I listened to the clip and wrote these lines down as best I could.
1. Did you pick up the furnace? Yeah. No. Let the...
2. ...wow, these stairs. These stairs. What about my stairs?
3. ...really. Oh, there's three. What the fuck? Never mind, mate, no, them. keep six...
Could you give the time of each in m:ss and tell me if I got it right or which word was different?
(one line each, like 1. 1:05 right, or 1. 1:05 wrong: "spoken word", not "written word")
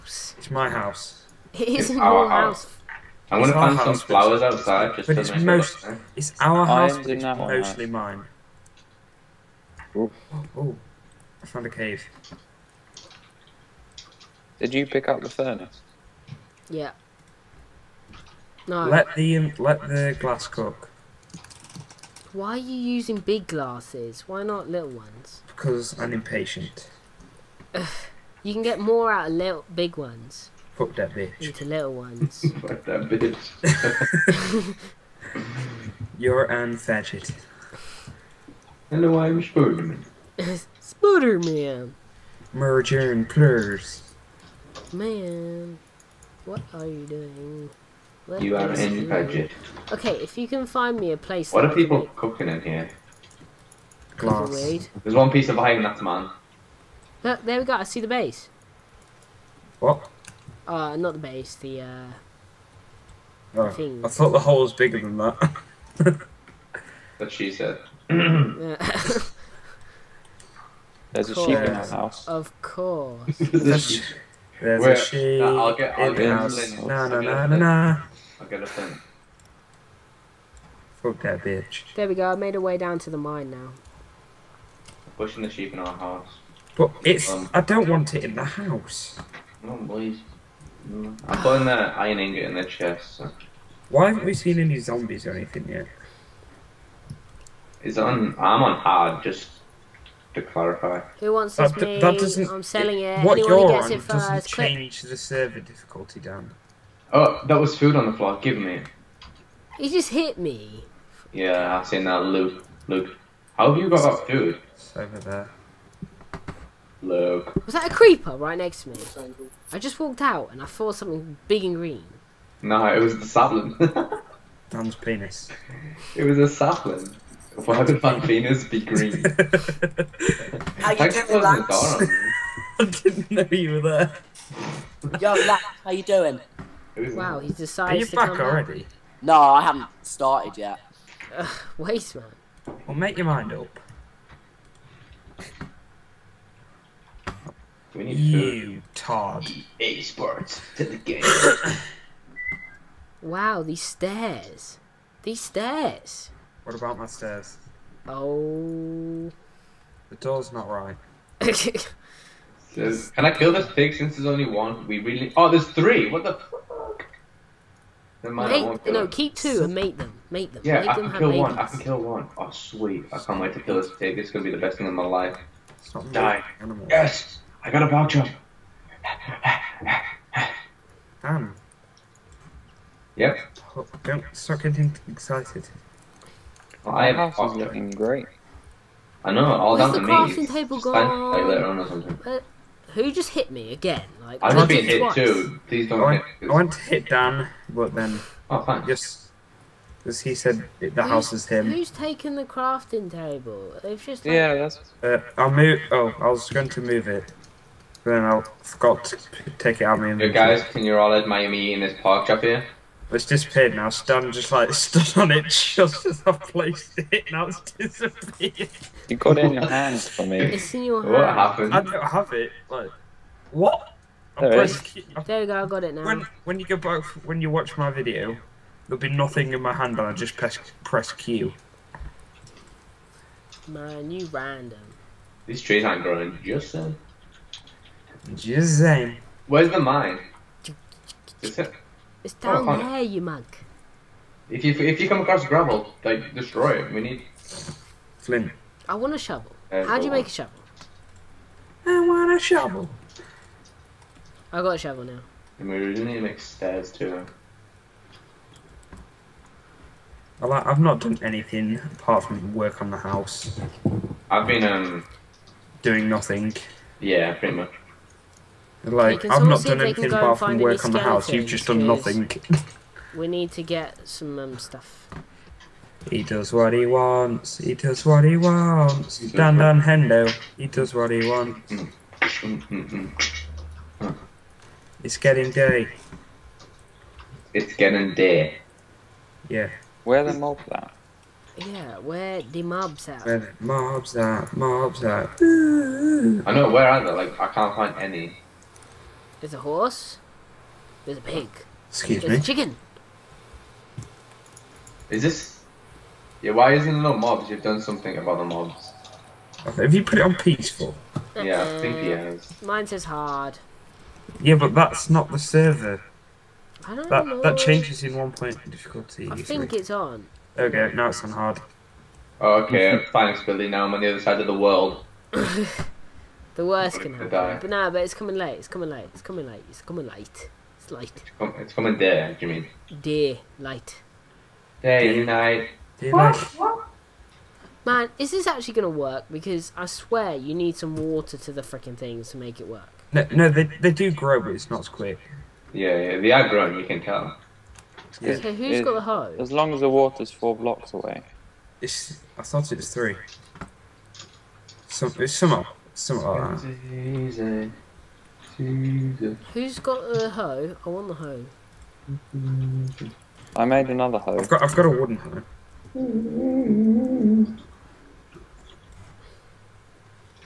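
1. 0:14 right
2. 2:33 right
3. 2:44 wrong: "two", not "six".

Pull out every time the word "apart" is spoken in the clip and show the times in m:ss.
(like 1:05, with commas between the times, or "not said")
4:21, 4:30.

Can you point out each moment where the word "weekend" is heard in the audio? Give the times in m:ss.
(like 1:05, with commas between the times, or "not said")
not said.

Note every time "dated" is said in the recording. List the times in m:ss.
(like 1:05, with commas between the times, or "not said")
not said.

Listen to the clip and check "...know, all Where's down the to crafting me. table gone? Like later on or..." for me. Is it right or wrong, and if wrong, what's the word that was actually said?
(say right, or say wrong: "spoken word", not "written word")
right.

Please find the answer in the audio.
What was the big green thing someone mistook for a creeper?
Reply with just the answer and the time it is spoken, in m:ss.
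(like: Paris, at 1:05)
A sapling, at 2:06.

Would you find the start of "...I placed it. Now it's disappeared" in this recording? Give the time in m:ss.
3:36.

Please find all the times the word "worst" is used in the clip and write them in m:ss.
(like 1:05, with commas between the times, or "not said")
5:26.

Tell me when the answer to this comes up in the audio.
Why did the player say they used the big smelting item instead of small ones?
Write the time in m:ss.
0:25.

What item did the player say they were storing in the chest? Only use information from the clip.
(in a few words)
Iron ingot.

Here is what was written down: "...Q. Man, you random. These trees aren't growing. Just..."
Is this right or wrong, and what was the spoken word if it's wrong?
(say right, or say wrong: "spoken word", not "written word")
right.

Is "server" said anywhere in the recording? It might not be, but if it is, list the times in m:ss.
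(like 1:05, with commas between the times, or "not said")
1:45, 5:15.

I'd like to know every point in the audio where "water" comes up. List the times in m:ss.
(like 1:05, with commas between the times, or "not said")
5:40, 5:49.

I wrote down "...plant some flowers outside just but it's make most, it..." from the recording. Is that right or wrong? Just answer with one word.
right.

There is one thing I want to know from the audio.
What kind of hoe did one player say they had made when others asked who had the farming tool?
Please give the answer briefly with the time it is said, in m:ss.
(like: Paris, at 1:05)
Wooden hoe, at 6:04.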